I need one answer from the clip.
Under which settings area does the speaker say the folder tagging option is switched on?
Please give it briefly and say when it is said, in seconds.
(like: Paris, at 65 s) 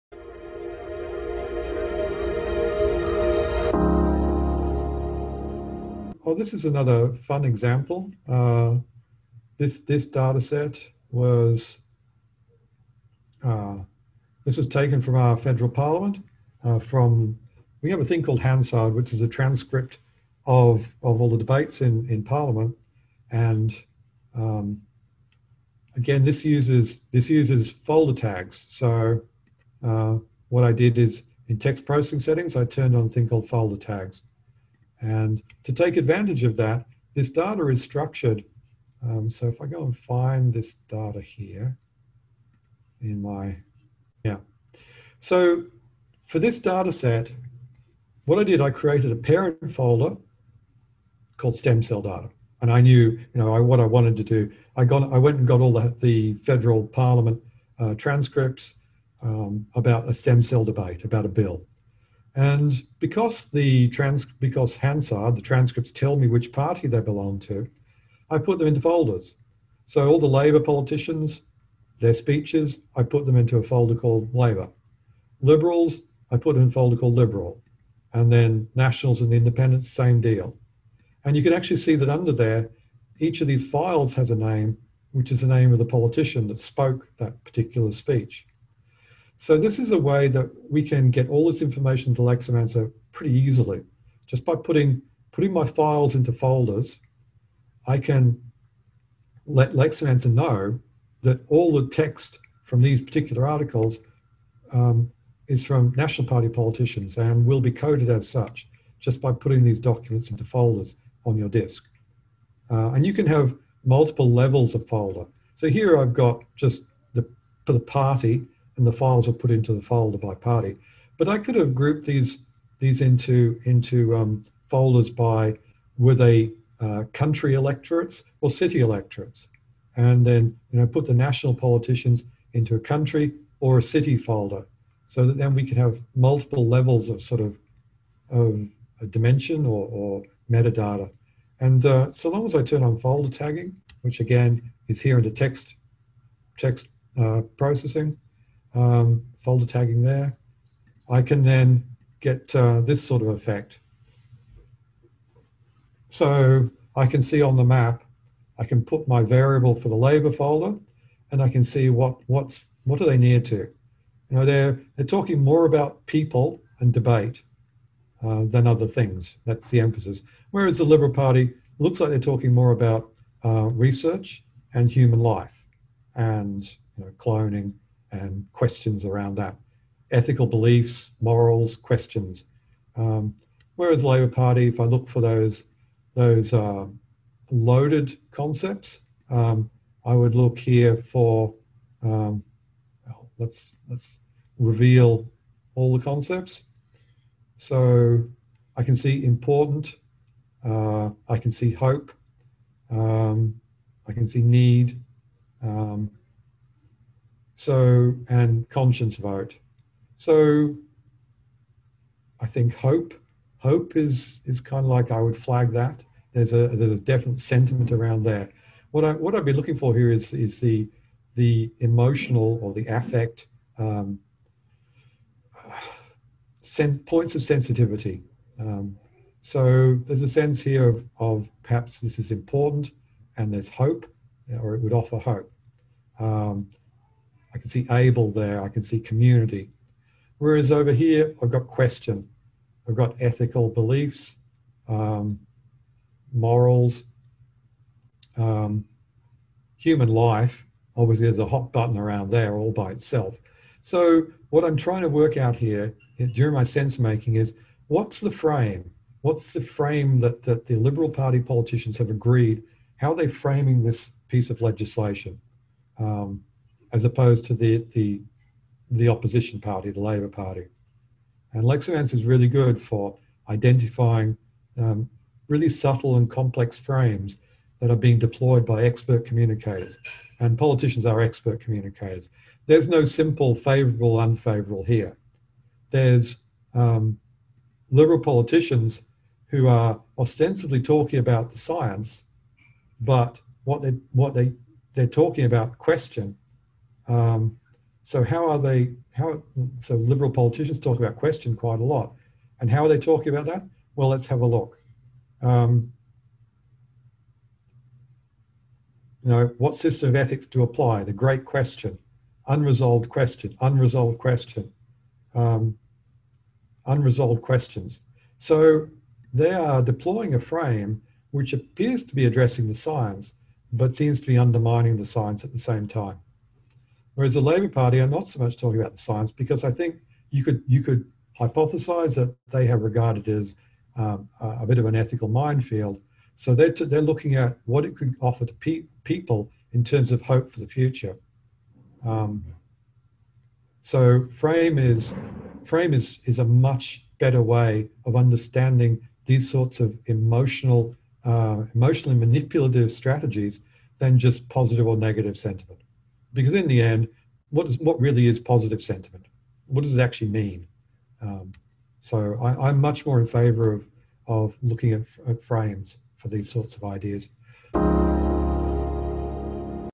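text processing, at 146 s.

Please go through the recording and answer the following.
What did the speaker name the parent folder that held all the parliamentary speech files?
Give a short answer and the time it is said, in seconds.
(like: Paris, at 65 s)
stem cell data, at 51 s.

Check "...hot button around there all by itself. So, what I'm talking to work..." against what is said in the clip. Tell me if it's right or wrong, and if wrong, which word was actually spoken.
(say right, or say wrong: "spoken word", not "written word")
wrong: "trying", not "talking".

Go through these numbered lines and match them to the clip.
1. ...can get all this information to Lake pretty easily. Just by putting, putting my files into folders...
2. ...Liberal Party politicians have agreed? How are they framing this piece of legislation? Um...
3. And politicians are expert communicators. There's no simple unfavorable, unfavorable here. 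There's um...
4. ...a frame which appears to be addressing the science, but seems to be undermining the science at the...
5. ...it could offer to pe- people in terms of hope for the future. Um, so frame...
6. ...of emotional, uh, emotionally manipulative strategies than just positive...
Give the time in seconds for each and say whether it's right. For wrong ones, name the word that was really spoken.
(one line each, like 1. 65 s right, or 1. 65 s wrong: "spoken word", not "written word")
1. 90 s right
2. 260 s right
3. 280 s wrong: "favorable", not "unfavorable"
4. 320 s right
5. 337 s right
6. 349 s right.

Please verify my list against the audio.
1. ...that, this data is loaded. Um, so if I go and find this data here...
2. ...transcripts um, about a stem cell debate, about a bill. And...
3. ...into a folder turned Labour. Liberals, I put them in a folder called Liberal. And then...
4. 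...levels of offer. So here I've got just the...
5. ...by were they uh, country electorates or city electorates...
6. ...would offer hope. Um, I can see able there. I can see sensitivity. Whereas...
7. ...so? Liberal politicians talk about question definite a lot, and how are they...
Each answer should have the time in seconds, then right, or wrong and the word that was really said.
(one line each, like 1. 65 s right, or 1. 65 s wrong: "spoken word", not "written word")
1. 36 s wrong: "structured", not "loaded"
2. 57 s right
3. 73 s wrong: "called", not "turned"
4. 114 s wrong: "folder", not "offer"
5. 125 s right
6. 234 s wrong: "community", not "sensitivity"
7. 299 s wrong: "quite", not "definite".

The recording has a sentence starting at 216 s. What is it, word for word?
There's a, there's a definite sentiment around that.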